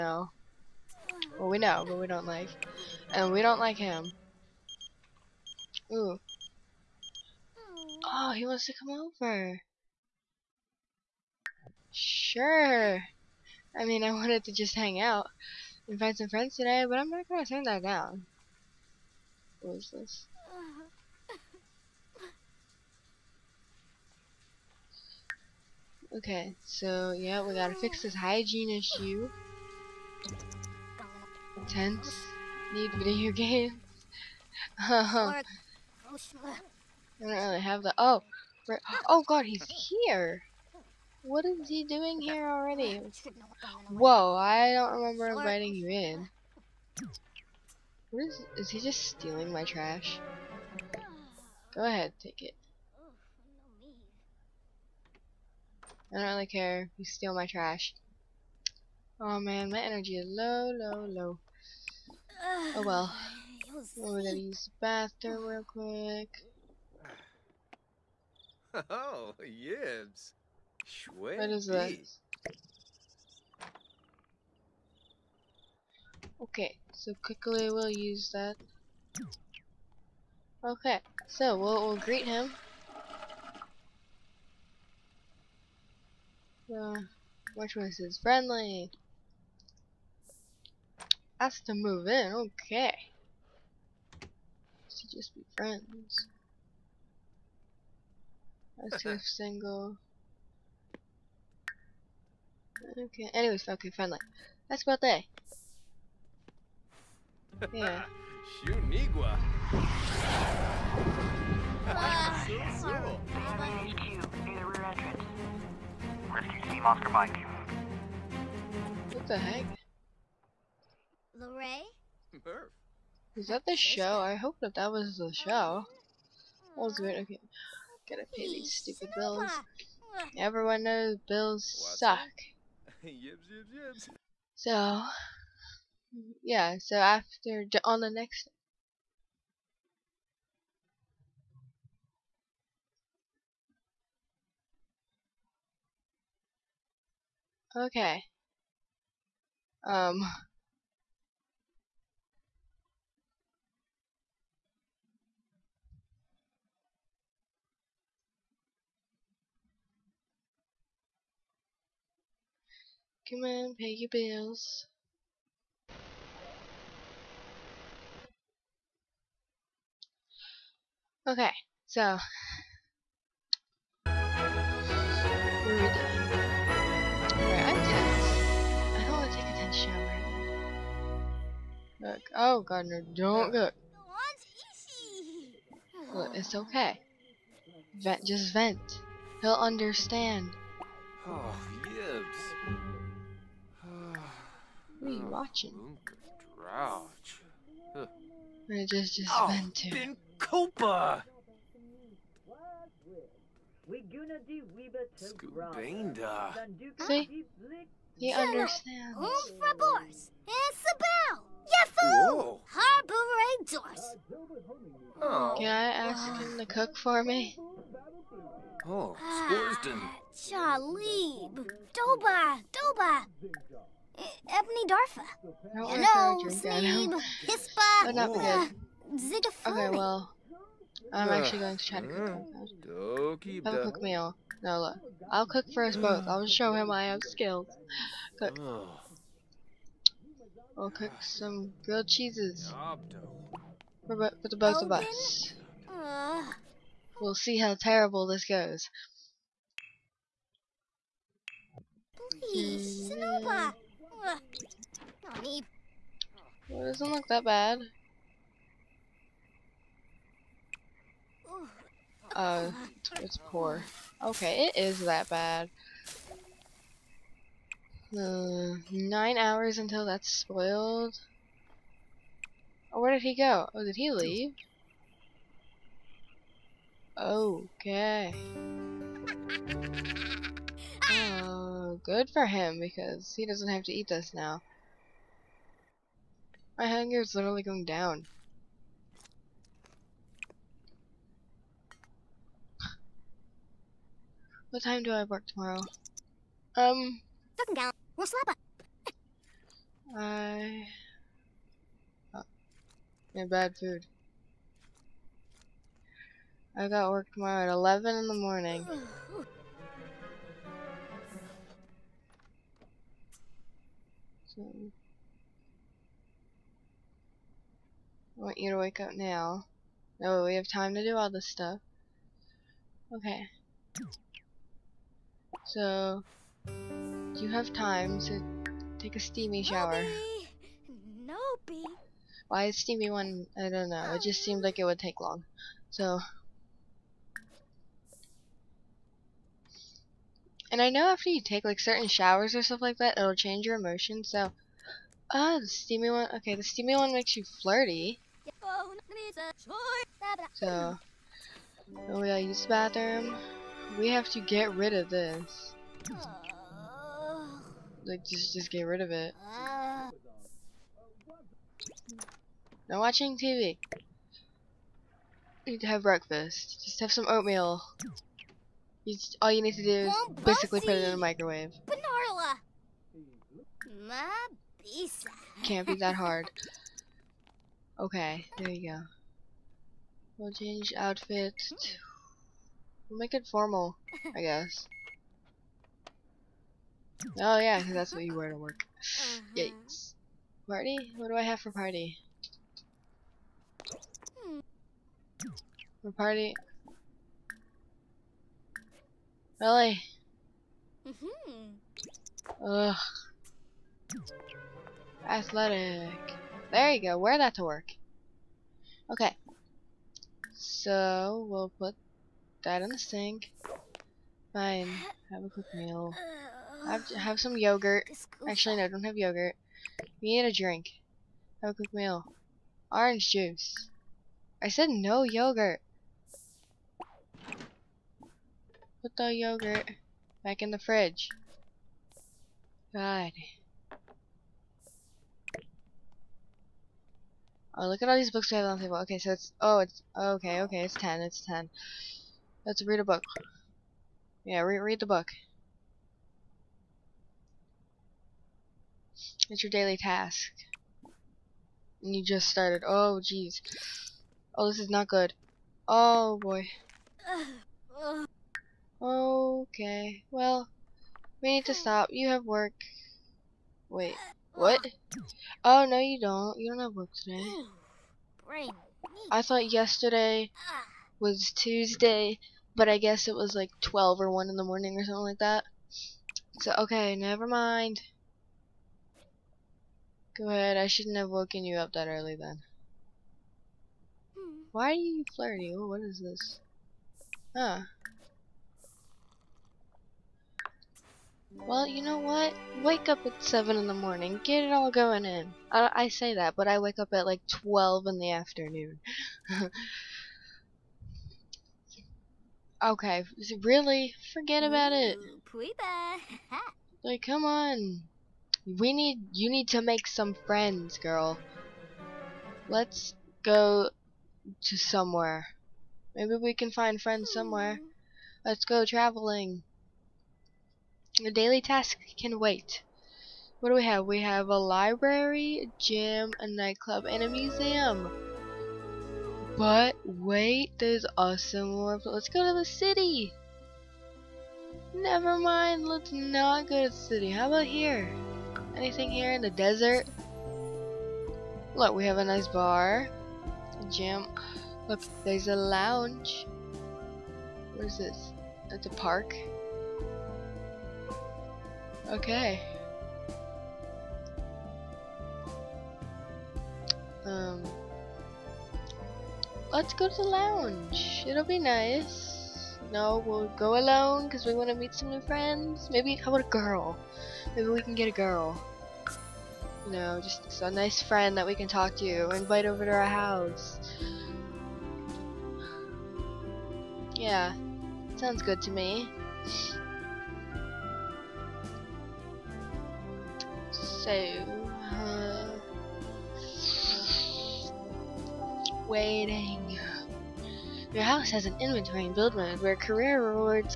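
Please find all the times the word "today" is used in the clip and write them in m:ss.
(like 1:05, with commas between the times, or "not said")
0:16, 7:47.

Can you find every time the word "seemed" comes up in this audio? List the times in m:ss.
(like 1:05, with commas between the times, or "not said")
5:34.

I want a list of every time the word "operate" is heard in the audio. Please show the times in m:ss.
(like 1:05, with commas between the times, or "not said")
not said.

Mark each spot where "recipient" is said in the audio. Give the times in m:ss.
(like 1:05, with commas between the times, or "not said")
not said.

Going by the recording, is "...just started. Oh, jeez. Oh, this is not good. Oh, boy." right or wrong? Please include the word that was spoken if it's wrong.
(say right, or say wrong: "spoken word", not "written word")
right.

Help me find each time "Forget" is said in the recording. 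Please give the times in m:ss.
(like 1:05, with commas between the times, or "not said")
8:24.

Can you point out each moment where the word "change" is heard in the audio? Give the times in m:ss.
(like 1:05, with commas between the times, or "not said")
5:43, 6:20.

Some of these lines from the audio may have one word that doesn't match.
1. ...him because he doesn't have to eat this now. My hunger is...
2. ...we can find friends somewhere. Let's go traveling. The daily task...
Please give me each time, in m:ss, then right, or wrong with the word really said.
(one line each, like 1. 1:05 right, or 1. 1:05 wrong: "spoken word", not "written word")
1. 4:42 right
2. 8:36 right.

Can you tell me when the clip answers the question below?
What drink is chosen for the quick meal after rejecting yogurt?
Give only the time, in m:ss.
7:02.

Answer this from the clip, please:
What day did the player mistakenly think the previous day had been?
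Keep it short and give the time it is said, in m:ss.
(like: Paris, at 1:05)
Tuesday, at 7:51.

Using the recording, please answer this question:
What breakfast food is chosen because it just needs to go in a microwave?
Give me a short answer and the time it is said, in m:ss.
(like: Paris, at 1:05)
Oatmeal, at 6:07.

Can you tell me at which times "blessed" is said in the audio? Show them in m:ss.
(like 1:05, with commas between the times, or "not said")
not said.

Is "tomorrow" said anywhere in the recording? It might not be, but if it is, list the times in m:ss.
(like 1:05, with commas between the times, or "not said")
4:55, 5:07.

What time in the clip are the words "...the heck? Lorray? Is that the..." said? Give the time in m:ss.
1:59.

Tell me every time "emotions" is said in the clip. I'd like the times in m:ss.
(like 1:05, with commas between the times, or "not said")
5:43.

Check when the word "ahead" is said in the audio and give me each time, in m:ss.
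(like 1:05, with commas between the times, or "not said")
0:51, 8:00.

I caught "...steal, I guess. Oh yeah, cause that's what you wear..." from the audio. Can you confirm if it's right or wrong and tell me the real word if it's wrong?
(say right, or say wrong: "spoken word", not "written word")
wrong: "formal", not "steal".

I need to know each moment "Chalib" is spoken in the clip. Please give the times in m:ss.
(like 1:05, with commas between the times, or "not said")
3:40.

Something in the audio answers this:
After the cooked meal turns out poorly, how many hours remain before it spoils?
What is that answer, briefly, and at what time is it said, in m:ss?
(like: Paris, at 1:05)
9, at 4:28.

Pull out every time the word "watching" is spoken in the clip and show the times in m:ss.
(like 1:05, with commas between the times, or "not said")
3:15, 6:02.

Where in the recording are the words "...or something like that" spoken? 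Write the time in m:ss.
7:54.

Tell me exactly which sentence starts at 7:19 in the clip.
Okay, so it's oh, it's okay, okay, it's ten, it's ten.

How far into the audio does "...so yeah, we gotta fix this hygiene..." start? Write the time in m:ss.
0:26.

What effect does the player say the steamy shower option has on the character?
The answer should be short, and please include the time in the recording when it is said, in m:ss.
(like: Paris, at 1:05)
Makes you flirty, at 5:47.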